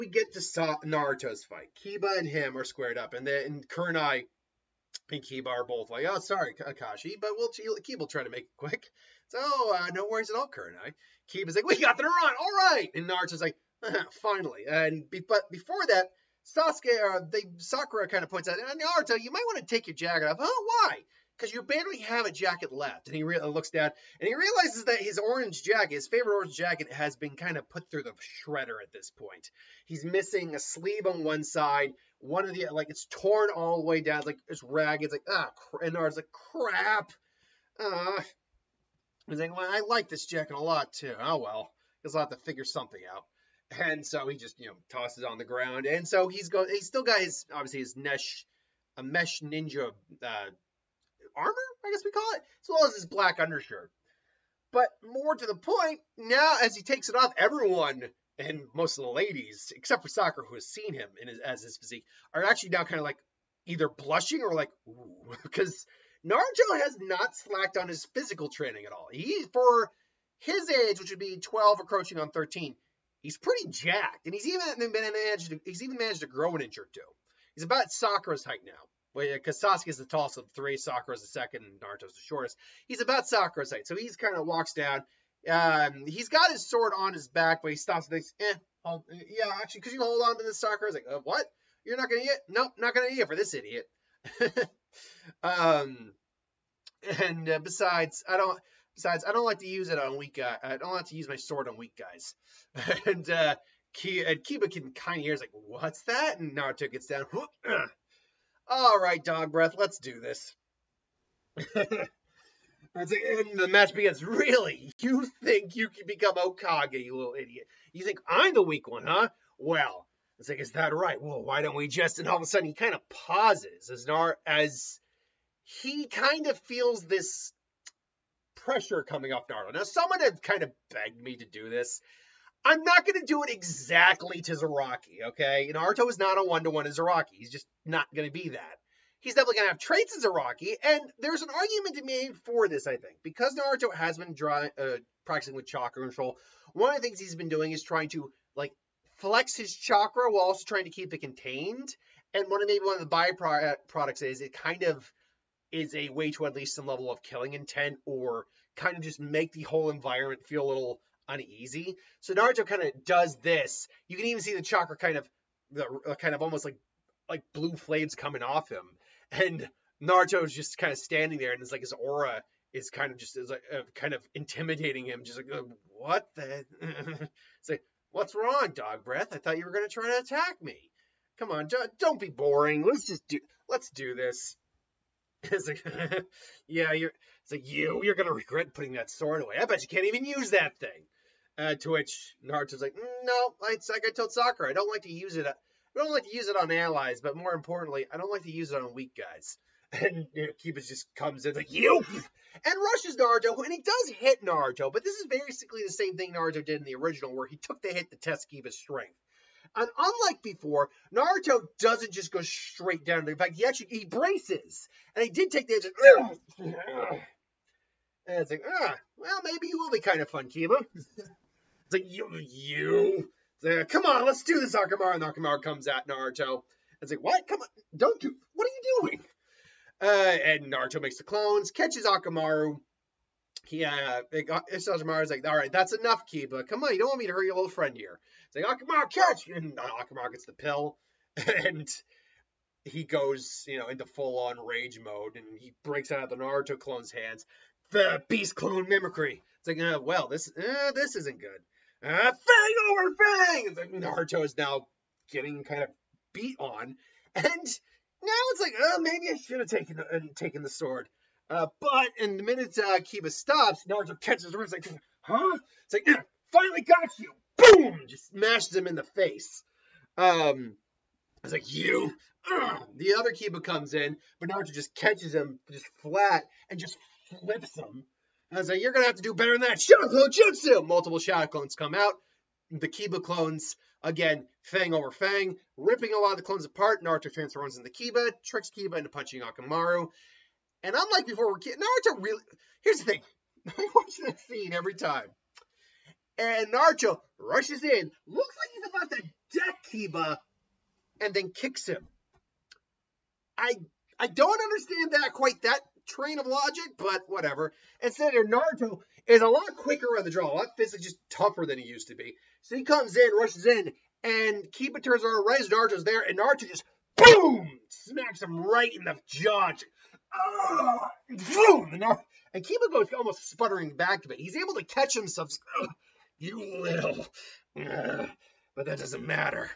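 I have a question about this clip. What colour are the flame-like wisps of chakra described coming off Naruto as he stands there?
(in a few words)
Blue.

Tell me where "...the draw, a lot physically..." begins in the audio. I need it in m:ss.
5:10.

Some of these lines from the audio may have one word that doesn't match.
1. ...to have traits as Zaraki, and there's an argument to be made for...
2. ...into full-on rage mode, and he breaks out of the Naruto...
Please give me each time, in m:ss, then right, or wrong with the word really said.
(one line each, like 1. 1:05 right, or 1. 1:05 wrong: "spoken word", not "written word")
1. 2:19 right
2. 4:03 right.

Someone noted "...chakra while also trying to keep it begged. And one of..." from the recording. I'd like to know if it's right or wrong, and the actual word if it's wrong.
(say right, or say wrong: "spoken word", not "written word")
wrong: "contained", not "begged".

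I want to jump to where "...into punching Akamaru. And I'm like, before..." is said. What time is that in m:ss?
4:48.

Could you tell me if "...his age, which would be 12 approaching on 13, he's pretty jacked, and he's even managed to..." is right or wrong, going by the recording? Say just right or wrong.
right.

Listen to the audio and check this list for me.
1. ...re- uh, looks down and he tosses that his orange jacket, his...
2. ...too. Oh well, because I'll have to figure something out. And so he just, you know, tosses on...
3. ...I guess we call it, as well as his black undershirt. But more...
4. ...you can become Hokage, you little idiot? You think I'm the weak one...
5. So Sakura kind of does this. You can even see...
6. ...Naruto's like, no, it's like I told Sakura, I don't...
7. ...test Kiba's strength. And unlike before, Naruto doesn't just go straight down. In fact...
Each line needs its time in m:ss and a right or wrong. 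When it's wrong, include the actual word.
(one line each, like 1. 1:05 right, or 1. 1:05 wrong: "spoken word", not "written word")
1. 0:23 wrong: "realizes", not "tosses"
2. 0:40 right
3. 0:51 right
4. 1:55 right
5. 2:42 wrong: "Naruto", not "Sakura"
6. 3:12 right
7. 3:28 right.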